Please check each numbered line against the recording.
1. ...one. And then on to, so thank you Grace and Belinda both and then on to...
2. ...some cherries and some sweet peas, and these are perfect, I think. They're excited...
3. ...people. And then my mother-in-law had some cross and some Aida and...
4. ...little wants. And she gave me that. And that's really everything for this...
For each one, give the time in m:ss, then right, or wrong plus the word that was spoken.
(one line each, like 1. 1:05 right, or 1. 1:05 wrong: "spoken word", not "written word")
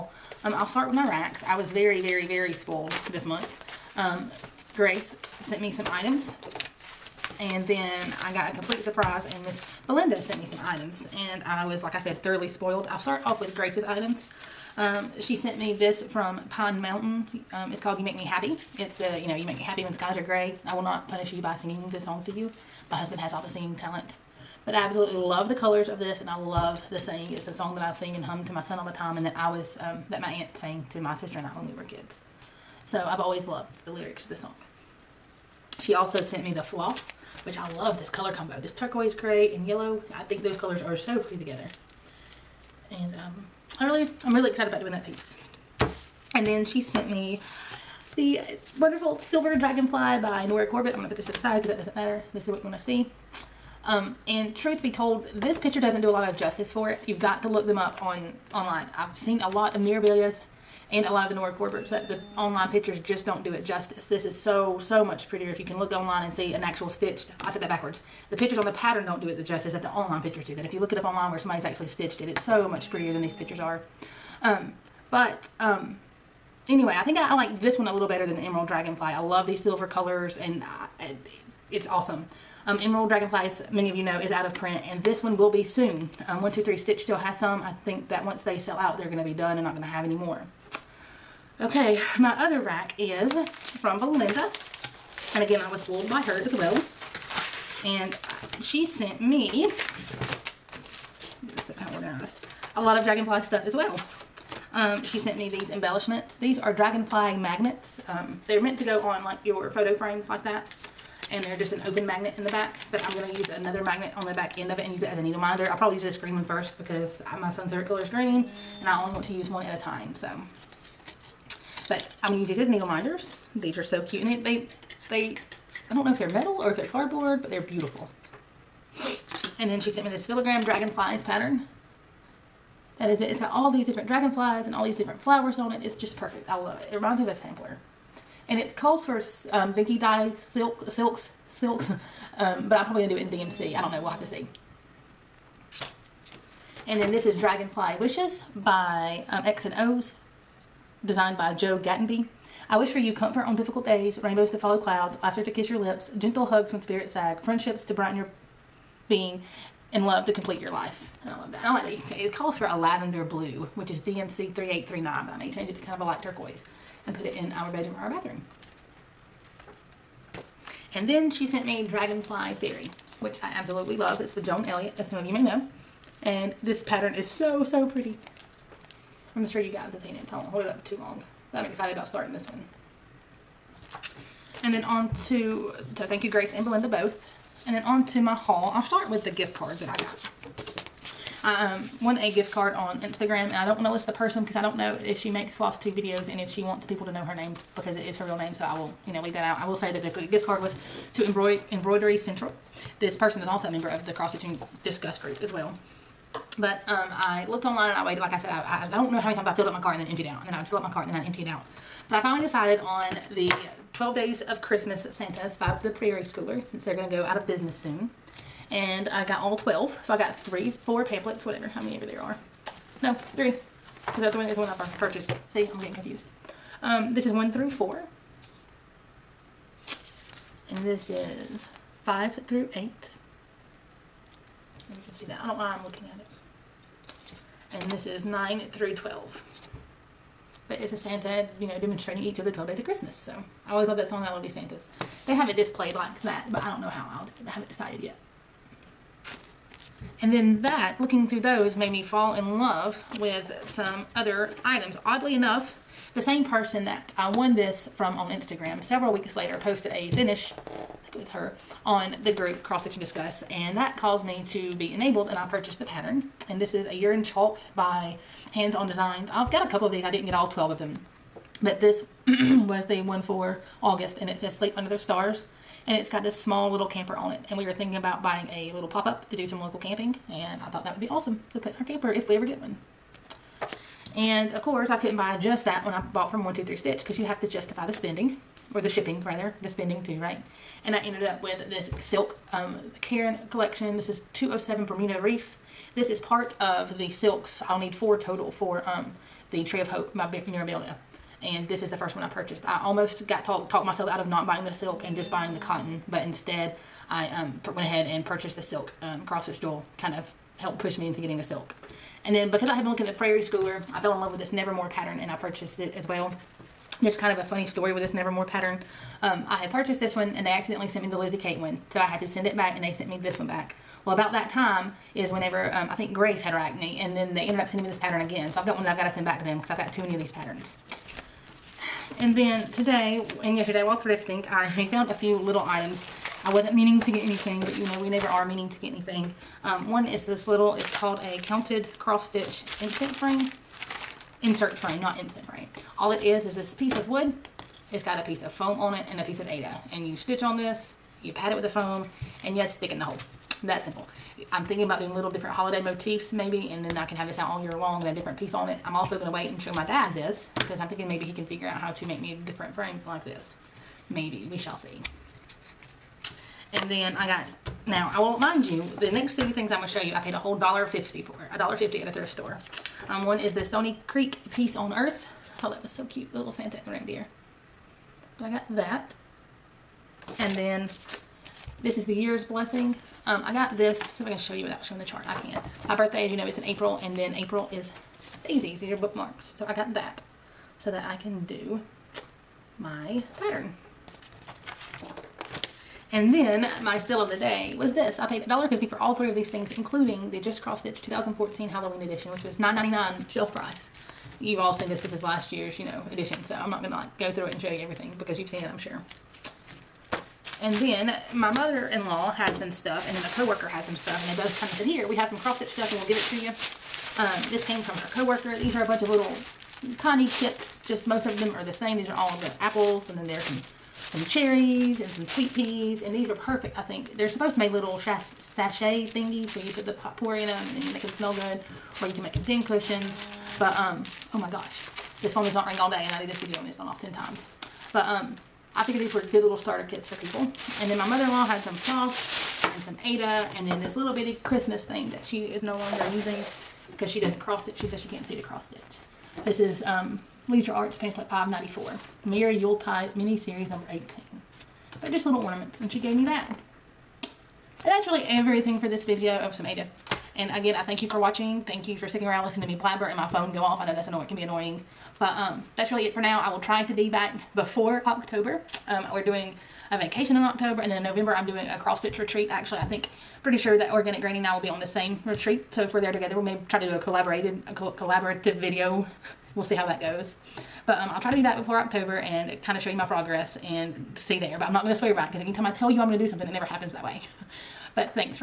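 1. 3:02 right
2. 7:03 wrong: "supposed", not "excited"
3. 7:20 wrong: "floss", not "cross"
4. 7:35 wrong: "ornaments", not "wants".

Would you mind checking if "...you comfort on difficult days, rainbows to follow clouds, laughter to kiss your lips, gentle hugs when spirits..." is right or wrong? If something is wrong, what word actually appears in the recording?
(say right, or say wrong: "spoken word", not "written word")
right.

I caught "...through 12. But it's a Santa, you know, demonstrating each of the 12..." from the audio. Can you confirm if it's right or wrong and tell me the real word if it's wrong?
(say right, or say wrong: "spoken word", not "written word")
right.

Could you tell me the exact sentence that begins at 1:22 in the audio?
Um, Emerald Dragonflies, many of you know, is out of print, and this one will be soon.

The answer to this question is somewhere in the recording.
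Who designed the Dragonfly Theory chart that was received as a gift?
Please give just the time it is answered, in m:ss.
2:54.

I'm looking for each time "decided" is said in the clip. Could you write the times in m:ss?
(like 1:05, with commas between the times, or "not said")
3:32, 4:07.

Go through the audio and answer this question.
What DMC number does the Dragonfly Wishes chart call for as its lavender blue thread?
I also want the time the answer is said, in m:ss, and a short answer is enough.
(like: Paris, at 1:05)
3839, at 2:44.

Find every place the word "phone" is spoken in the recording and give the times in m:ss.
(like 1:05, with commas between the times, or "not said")
7:15, 7:43.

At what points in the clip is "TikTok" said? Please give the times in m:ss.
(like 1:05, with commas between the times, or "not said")
not said.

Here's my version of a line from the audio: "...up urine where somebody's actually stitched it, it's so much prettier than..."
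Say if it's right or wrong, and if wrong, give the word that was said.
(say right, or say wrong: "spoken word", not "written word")
wrong: "online", not "urine".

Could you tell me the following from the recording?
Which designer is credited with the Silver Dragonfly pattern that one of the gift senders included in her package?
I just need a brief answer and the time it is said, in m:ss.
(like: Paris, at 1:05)
Nora Corbett, at 0:50.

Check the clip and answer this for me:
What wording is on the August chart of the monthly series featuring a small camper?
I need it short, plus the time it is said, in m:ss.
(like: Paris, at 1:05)
Sleep Under the Stars, at 4:34.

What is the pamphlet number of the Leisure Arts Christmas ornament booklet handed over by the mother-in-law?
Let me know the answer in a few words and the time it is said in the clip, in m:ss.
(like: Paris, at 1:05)
594, at 7:31.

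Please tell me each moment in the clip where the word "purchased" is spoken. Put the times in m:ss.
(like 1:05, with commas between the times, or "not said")
3:44, 4:25, 5:02, 5:08, 5:15, 5:19.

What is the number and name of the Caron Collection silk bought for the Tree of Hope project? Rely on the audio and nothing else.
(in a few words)
207 Bermuda Reef.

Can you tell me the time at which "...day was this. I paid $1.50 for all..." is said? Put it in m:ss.
6:37.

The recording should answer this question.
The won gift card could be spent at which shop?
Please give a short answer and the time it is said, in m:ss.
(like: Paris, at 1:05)
Embroidery Central, at 3:21.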